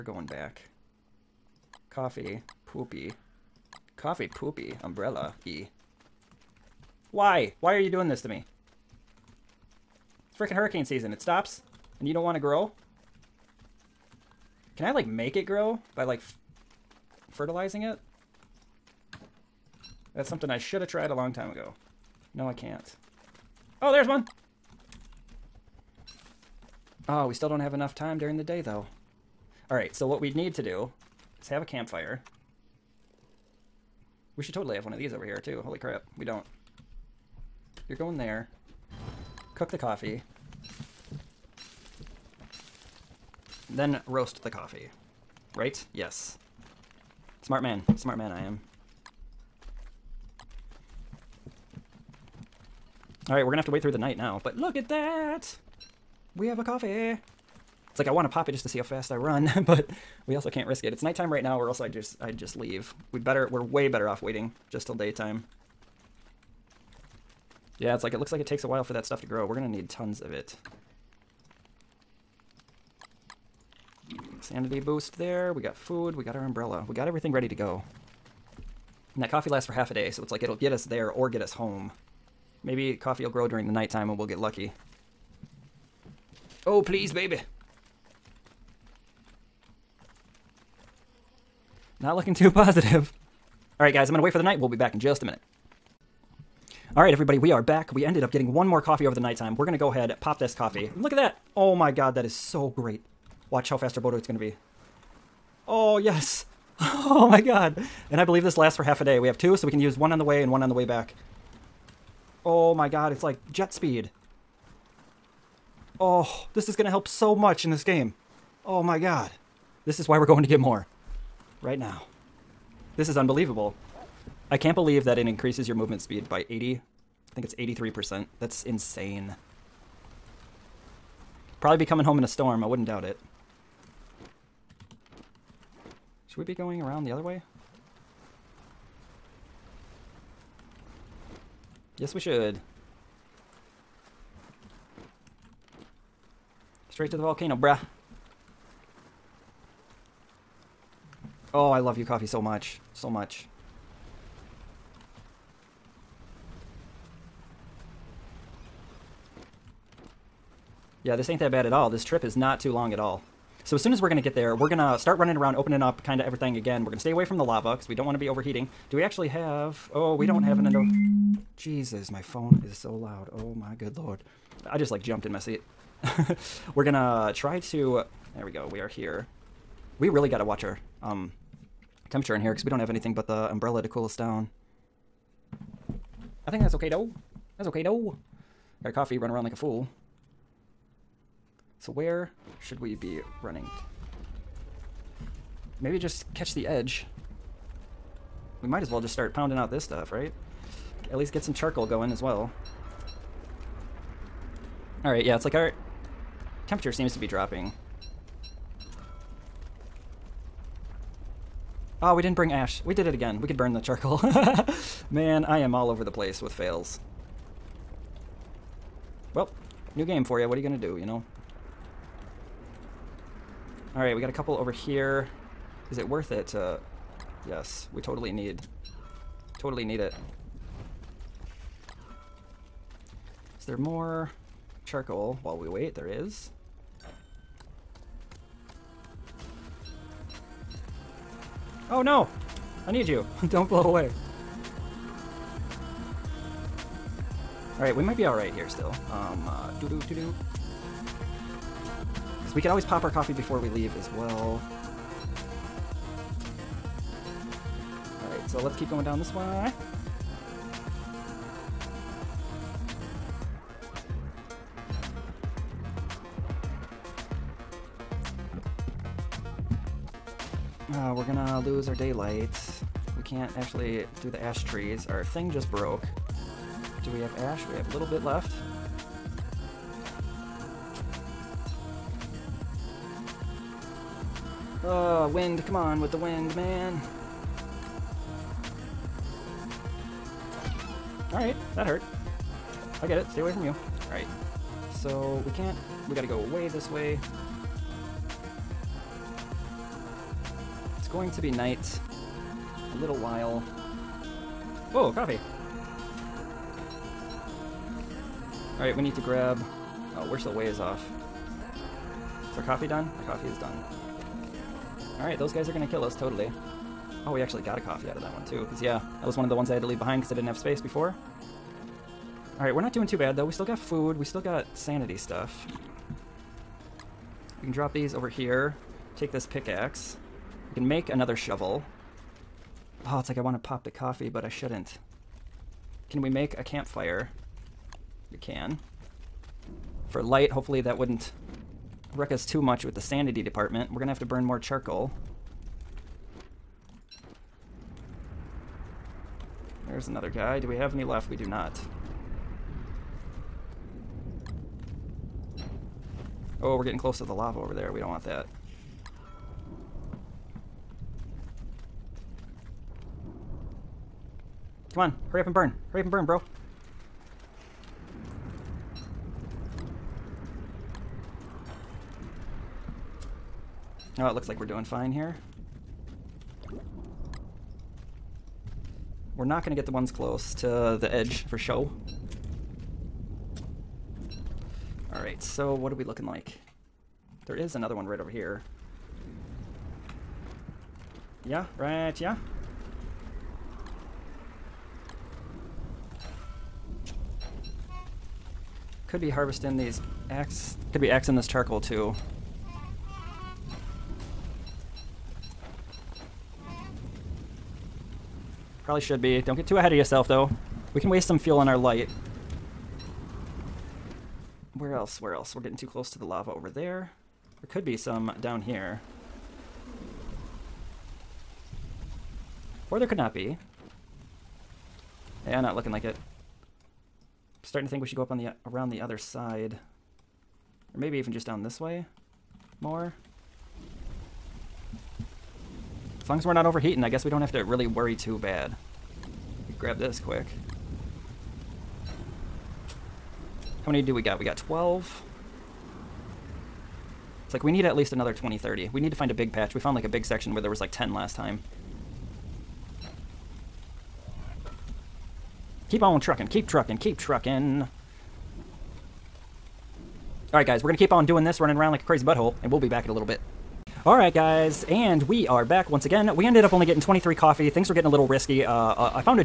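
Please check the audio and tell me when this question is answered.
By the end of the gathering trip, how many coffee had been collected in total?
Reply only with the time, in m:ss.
7:47.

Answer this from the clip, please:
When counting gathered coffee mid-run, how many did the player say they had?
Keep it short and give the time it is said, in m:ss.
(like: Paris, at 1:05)
12, at 7:24.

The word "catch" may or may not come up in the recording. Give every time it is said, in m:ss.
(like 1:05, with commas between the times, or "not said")
3:16.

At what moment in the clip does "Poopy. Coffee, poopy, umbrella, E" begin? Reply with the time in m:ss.
0:02.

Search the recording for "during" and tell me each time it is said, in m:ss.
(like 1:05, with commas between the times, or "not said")
0:28, 1:23.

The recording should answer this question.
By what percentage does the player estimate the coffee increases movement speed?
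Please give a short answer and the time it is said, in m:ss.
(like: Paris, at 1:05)
83%, at 2:07.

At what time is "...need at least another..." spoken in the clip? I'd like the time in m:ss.
7:27.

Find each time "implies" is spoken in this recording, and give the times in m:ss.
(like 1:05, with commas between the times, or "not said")
not said.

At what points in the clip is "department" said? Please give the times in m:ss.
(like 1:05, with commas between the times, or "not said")
5:43.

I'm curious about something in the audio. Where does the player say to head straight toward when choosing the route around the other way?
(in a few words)
the volcano.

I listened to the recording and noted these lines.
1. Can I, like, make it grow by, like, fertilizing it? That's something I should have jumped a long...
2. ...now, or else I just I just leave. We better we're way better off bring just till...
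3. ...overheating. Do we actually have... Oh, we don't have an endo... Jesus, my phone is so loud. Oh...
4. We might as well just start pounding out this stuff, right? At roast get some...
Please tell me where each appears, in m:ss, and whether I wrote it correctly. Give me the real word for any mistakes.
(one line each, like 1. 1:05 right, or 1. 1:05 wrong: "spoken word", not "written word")
1. 0:14 wrong: "tried", not "jumped"
2. 1:01 wrong: "waiting", not "bring"
3. 2:48 right
4. 3:18 wrong: "least", not "roast".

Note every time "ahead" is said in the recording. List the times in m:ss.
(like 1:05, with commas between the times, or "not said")
1:39, 6:49.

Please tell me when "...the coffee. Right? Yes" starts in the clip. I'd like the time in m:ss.
0:44.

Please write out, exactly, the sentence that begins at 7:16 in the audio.
As long as we're not overheating, I guess we don't have to really worry too bad.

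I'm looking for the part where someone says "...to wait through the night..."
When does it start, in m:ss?
0:53.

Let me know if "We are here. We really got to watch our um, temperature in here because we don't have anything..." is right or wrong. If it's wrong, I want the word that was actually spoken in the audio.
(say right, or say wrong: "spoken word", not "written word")
right.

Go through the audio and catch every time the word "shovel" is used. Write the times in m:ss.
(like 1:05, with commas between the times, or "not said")
5:31.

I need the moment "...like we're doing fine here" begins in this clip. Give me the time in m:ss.
6:14.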